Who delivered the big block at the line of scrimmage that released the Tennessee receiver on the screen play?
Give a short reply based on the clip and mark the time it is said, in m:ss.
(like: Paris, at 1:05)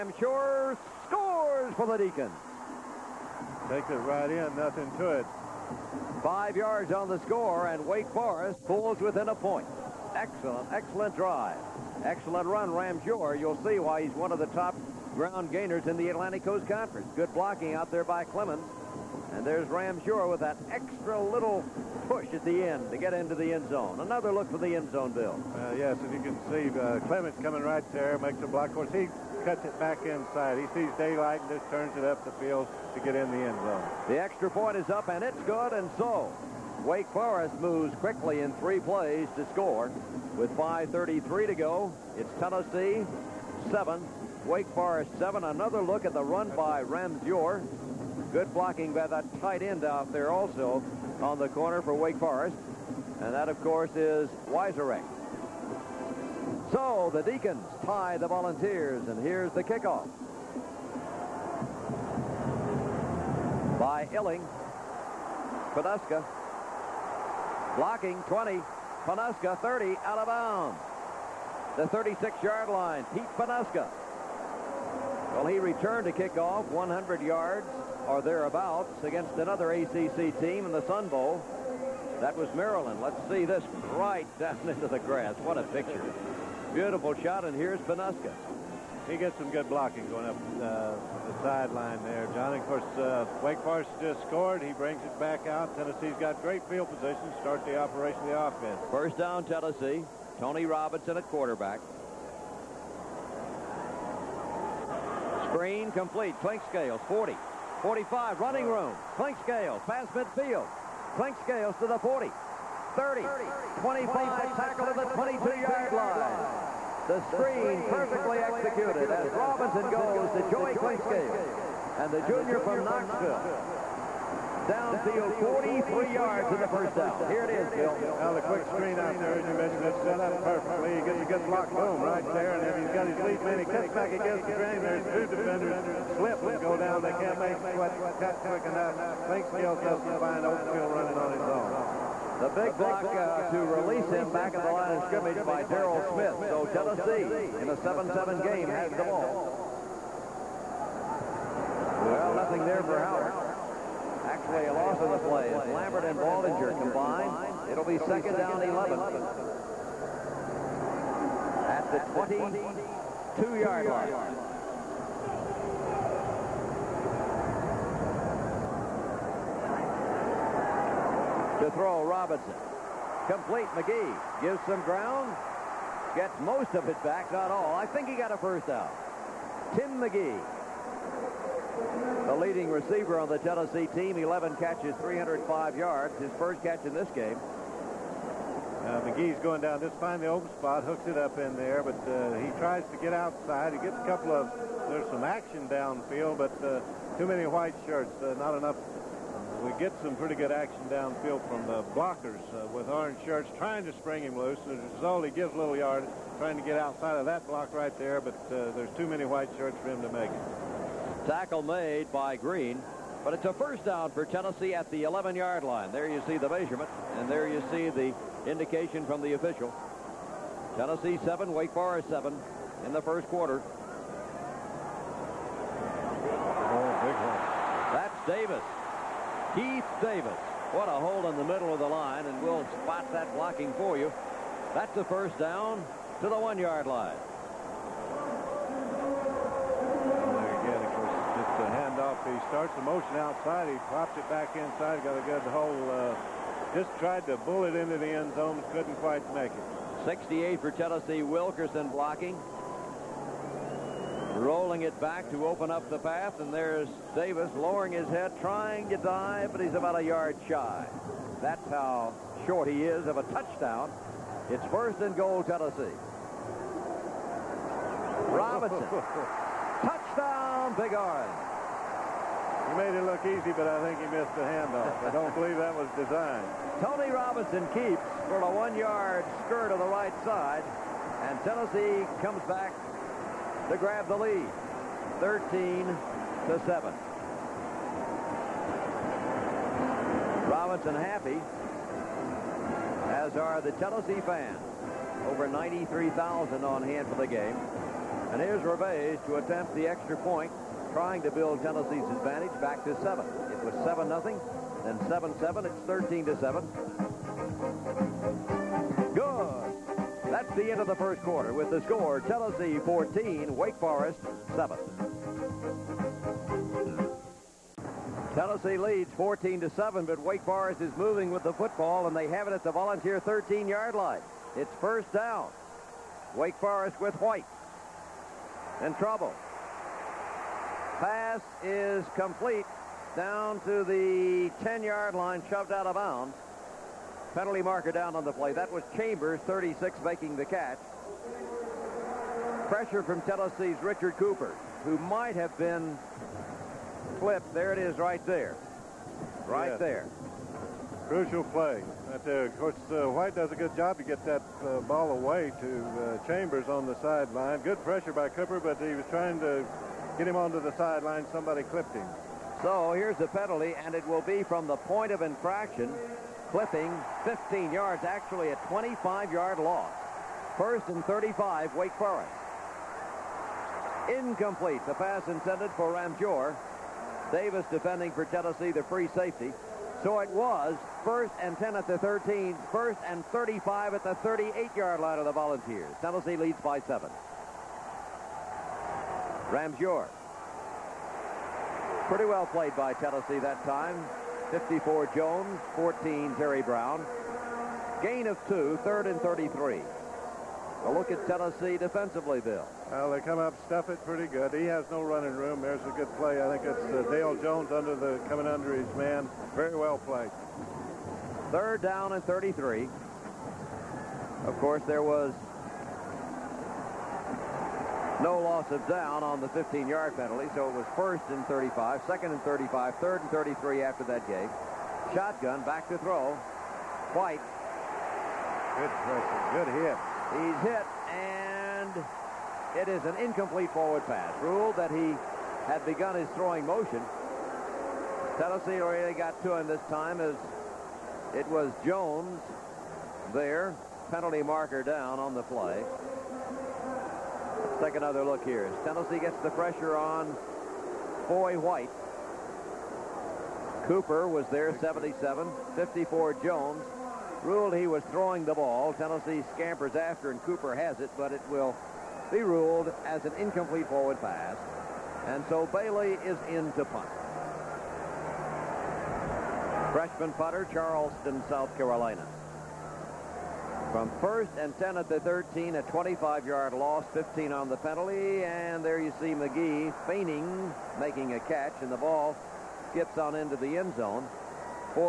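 Daryl Smith, at 2:25.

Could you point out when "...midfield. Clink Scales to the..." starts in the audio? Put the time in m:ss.
1:50.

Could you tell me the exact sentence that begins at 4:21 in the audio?
That's how short he is of a touchdown.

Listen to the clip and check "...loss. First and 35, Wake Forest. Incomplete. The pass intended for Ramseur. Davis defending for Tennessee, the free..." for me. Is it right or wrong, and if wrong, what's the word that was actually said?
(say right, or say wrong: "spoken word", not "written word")
right.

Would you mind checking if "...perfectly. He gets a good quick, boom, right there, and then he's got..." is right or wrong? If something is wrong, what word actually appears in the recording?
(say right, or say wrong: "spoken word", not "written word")
wrong: "block", not "quick".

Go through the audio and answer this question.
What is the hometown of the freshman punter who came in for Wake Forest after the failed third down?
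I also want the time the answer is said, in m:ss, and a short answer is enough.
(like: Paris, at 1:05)
Charleston, South Carolina, at 7:50.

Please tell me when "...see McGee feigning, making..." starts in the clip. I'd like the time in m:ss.
7:59.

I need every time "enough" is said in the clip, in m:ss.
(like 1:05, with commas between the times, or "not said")
2:18, 3:18.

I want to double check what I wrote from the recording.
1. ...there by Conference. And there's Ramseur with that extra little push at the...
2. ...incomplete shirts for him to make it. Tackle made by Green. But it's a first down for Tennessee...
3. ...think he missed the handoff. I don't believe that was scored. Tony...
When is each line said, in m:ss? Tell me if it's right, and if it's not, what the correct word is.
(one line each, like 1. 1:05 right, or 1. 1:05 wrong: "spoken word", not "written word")
1. 0:17 wrong: "Clemons", not "Conference"
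2. 3:29 wrong: "white", not "incomplete"
3. 4:33 wrong: "designed", not "scored".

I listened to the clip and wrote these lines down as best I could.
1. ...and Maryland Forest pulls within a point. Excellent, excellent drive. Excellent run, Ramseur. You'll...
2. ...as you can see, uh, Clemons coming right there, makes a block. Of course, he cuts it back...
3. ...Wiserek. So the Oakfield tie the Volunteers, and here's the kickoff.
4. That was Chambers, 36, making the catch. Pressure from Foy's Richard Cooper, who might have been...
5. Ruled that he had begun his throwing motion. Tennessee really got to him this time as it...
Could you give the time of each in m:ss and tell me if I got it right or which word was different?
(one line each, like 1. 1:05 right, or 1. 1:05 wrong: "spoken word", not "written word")
1. 0:07 wrong: "Wake", not "Maryland"
2. 0:26 right
3. 0:54 wrong: "Deacons", not "Oakfield"
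4. 5:38 wrong: "Tennessee", not "Foy"
5. 7:14 right.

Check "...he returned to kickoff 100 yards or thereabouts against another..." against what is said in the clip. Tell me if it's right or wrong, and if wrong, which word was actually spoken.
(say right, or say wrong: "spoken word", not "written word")
right.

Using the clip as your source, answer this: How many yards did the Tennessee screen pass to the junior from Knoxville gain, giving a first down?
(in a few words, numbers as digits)
43.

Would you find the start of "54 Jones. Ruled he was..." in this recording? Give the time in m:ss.
7:35.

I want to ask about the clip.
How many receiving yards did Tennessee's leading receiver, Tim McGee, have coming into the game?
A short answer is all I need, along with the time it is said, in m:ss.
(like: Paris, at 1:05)
305, at 3:05.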